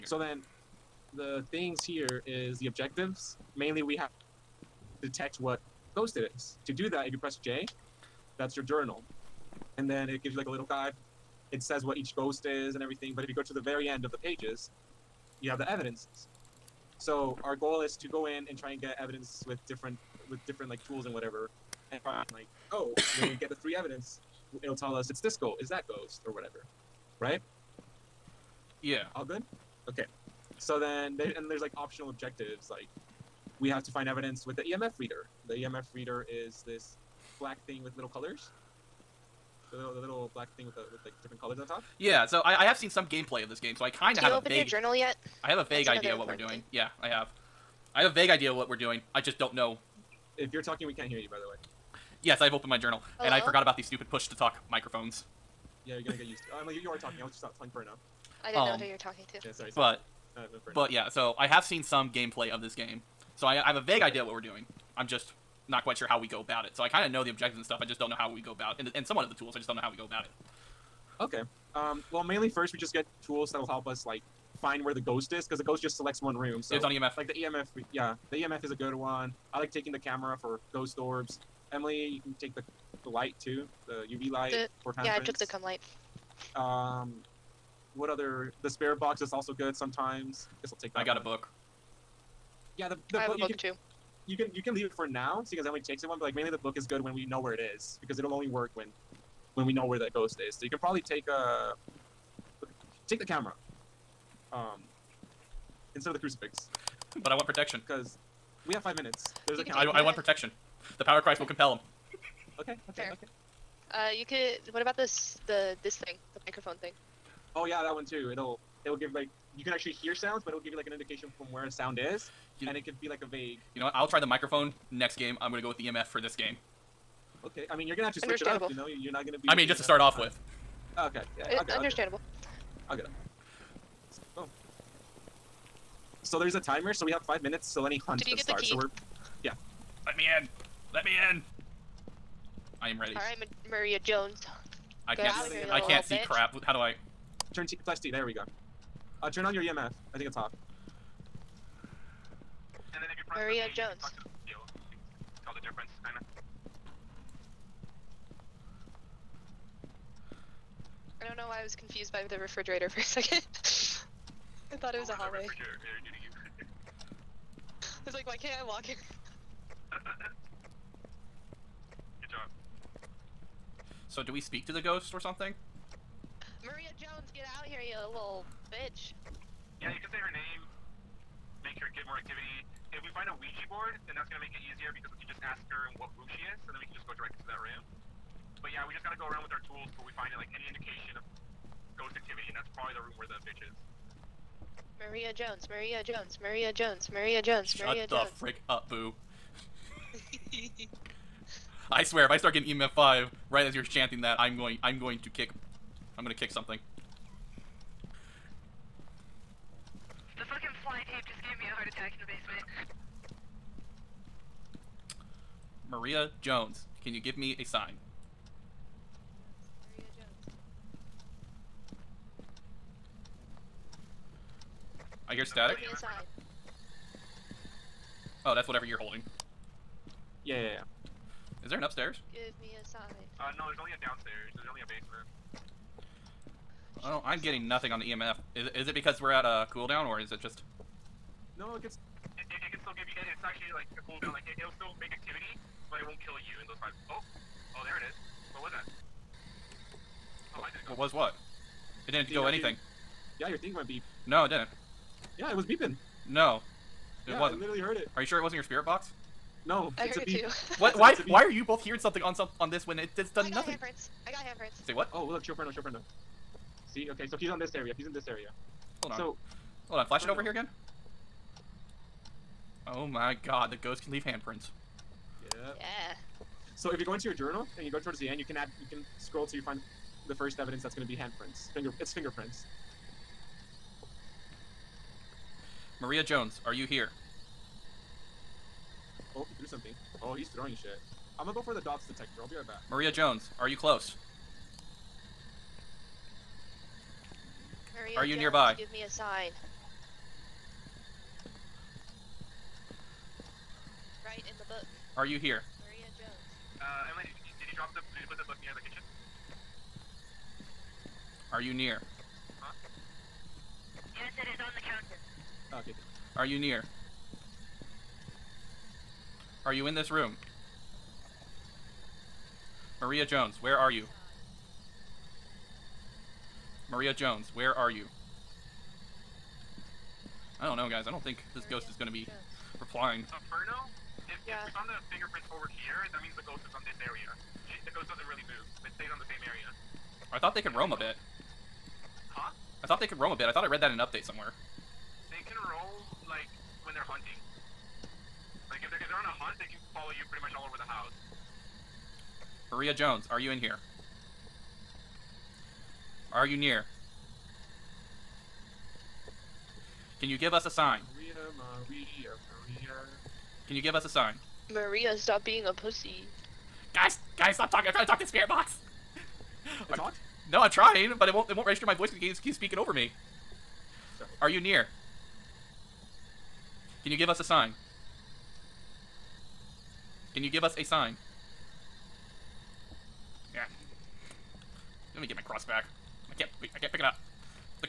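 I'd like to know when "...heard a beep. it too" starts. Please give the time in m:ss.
4:20.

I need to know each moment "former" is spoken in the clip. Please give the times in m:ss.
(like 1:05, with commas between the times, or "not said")
not said.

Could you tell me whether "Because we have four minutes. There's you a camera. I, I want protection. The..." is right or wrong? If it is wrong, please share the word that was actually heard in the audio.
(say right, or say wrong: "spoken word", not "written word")
wrong: "five", not "four".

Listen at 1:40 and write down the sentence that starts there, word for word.
So you can probably take uh take the camera.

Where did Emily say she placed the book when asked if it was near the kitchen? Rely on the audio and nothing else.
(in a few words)
On the counter.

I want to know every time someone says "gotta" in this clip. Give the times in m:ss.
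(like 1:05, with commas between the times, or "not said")
3:09.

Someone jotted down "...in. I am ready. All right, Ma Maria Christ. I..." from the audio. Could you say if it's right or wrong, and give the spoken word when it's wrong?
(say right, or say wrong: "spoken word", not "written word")
wrong: "Jones", not "Christ".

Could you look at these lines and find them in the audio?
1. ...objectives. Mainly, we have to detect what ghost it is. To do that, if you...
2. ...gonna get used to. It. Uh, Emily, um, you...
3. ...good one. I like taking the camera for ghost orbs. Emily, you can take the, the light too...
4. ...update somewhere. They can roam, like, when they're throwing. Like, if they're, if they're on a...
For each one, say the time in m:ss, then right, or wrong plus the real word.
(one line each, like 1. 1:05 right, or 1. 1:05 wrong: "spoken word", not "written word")
1. 0:02 right
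2. 0:56 right
3. 1:18 right
4. 5:44 wrong: "hunting", not "throwing".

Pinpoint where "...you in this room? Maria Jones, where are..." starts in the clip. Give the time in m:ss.
5:19.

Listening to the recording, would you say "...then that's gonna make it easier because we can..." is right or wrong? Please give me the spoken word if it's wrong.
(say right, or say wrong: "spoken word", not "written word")
right.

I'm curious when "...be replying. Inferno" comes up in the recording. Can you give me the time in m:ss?
5:32.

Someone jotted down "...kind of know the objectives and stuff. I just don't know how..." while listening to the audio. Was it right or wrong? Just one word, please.
right.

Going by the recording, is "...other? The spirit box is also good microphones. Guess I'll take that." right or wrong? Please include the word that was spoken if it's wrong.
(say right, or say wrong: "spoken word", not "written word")
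wrong: "sometimes", not "microphones".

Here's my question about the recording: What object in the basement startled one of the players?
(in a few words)
fly tape.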